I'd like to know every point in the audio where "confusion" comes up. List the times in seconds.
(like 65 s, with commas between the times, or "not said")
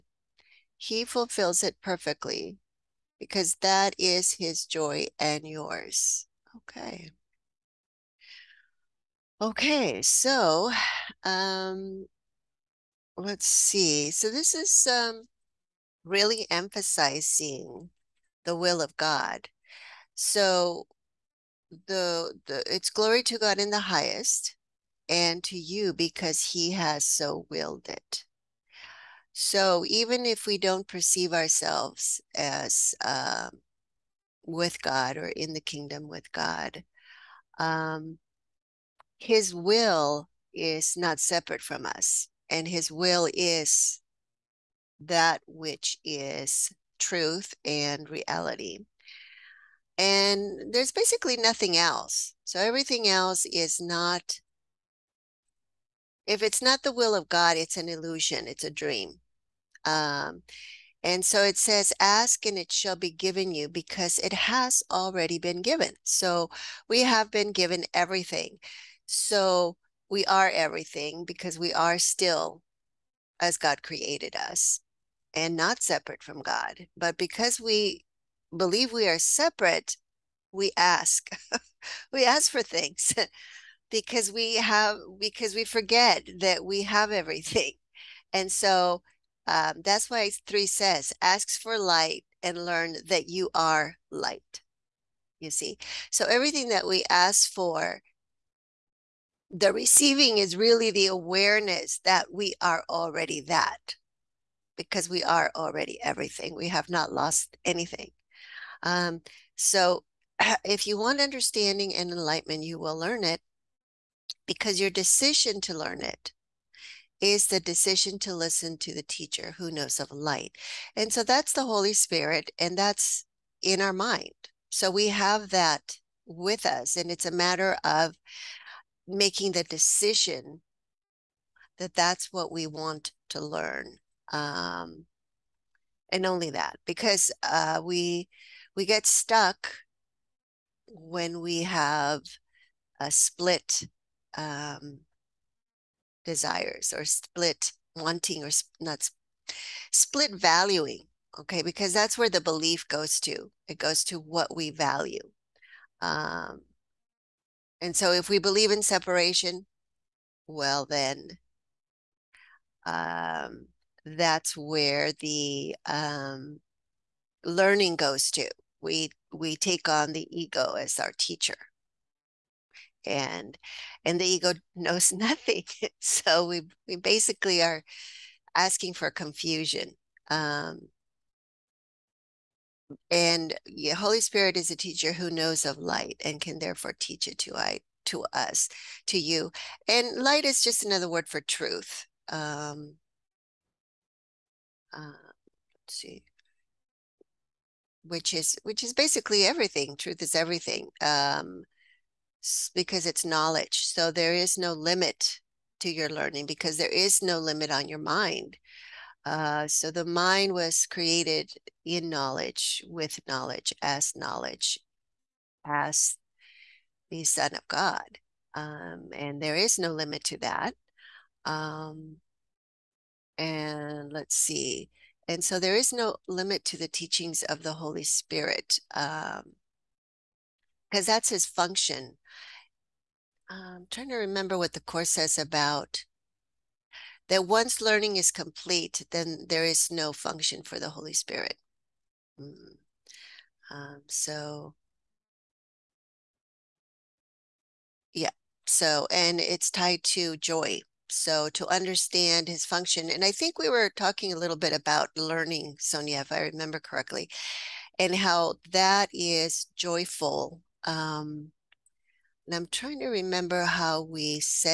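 179 s.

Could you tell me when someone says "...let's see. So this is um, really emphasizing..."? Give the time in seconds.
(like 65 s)
13 s.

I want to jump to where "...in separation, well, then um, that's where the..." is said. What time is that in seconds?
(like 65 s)
158 s.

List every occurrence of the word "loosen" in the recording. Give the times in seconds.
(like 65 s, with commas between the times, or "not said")
not said.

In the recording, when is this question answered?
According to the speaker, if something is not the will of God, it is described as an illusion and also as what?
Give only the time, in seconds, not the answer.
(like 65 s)
58 s.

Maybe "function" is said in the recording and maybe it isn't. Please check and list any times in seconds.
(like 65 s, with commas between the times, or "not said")
231 s, 240 s, 252 s.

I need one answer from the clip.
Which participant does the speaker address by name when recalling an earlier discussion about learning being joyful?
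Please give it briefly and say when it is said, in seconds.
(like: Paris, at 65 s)
Sonia, at 255 s.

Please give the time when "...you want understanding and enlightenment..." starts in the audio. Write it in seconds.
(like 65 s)
110 s.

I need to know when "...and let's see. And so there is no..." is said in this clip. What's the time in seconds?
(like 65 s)
223 s.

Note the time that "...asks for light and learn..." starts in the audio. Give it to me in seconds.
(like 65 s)
91 s.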